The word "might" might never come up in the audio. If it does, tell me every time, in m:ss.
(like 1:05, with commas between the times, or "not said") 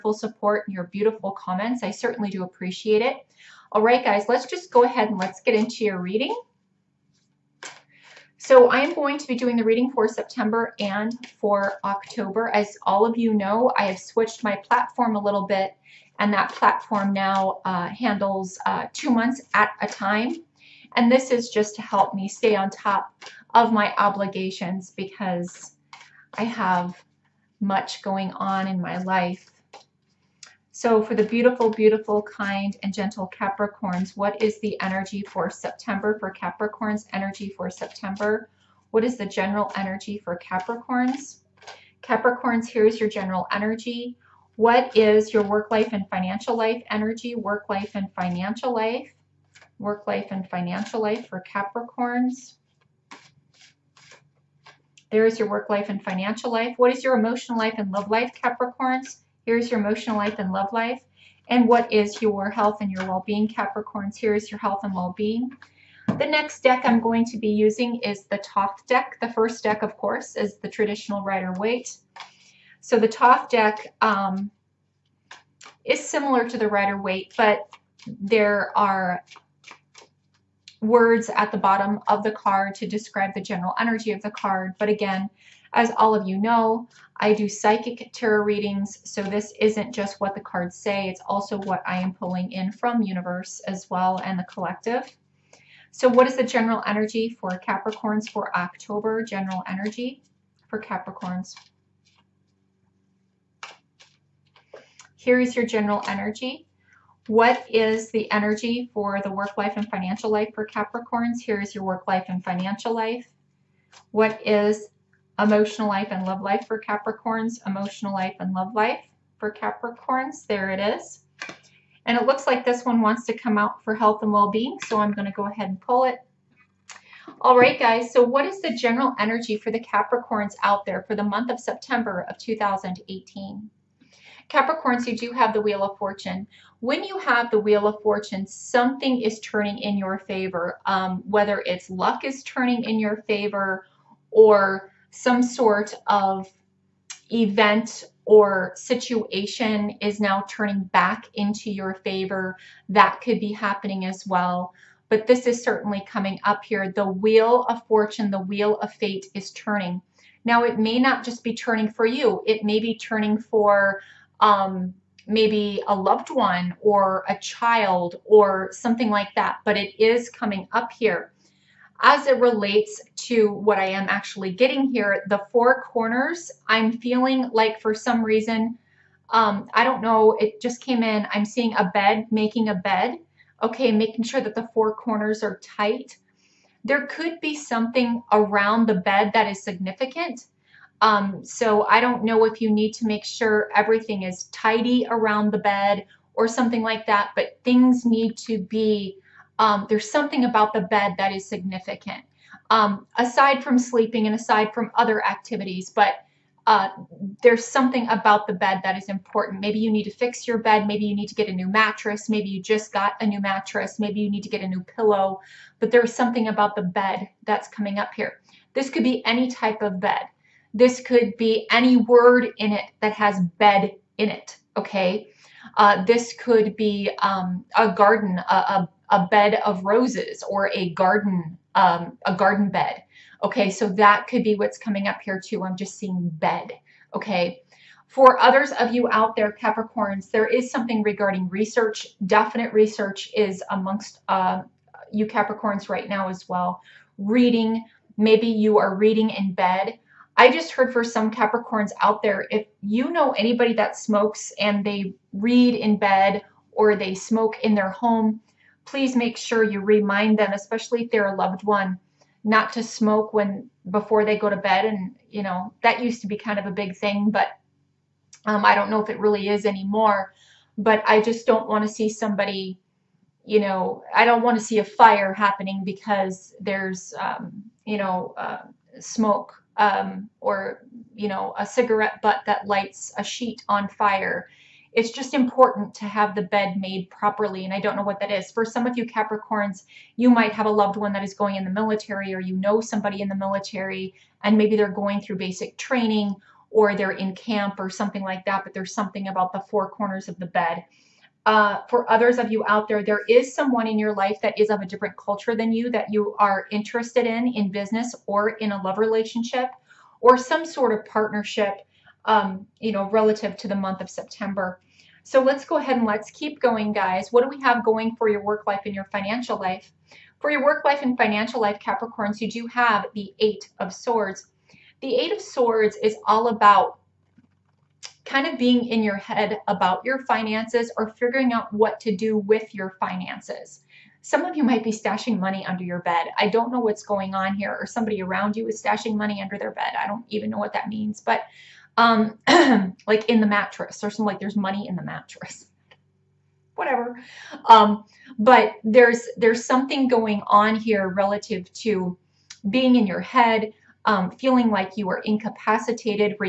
4:50, 5:34.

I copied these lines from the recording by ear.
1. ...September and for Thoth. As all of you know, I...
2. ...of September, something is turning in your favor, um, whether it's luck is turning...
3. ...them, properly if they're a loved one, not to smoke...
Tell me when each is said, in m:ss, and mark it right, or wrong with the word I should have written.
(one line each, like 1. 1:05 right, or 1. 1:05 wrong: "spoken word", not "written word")
1. 0:10 wrong: "October", not "Thoth"
2. 2:17 wrong: "Fortune", not "September"
3. 4:20 wrong: "especially", not "properly".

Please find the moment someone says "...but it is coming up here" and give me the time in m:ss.
2:49.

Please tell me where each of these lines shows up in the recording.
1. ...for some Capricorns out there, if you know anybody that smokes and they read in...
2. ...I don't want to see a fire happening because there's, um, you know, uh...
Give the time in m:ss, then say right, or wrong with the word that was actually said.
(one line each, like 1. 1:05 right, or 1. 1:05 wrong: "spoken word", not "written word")
1. 4:10 right
2. 4:34 right.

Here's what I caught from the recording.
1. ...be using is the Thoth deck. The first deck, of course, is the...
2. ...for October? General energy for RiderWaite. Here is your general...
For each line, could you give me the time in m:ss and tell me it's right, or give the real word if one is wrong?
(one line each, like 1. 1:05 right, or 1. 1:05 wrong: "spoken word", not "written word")
1. 1:07 right
2. 1:38 wrong: "Capricorns", not "RiderWaite".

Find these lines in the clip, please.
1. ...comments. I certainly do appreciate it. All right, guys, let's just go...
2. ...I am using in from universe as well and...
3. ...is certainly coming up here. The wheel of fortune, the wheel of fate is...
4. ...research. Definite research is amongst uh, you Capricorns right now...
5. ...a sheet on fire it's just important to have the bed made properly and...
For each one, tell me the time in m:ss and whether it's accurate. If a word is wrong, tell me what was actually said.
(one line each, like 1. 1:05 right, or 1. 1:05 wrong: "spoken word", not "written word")
1. 0:01 right
2. 1:31 wrong: "pulling", not "using"
3. 2:35 right
4. 4:01 right
5. 4:43 right.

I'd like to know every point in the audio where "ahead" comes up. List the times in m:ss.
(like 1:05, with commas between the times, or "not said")
0:04, 2:05, 5:15.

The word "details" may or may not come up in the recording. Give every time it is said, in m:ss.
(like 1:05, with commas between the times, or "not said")
not said.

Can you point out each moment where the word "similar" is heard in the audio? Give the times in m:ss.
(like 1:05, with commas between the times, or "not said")
1:15.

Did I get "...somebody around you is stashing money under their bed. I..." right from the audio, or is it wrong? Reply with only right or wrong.
right.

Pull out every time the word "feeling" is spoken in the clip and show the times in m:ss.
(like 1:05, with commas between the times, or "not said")
2:56, 5:54.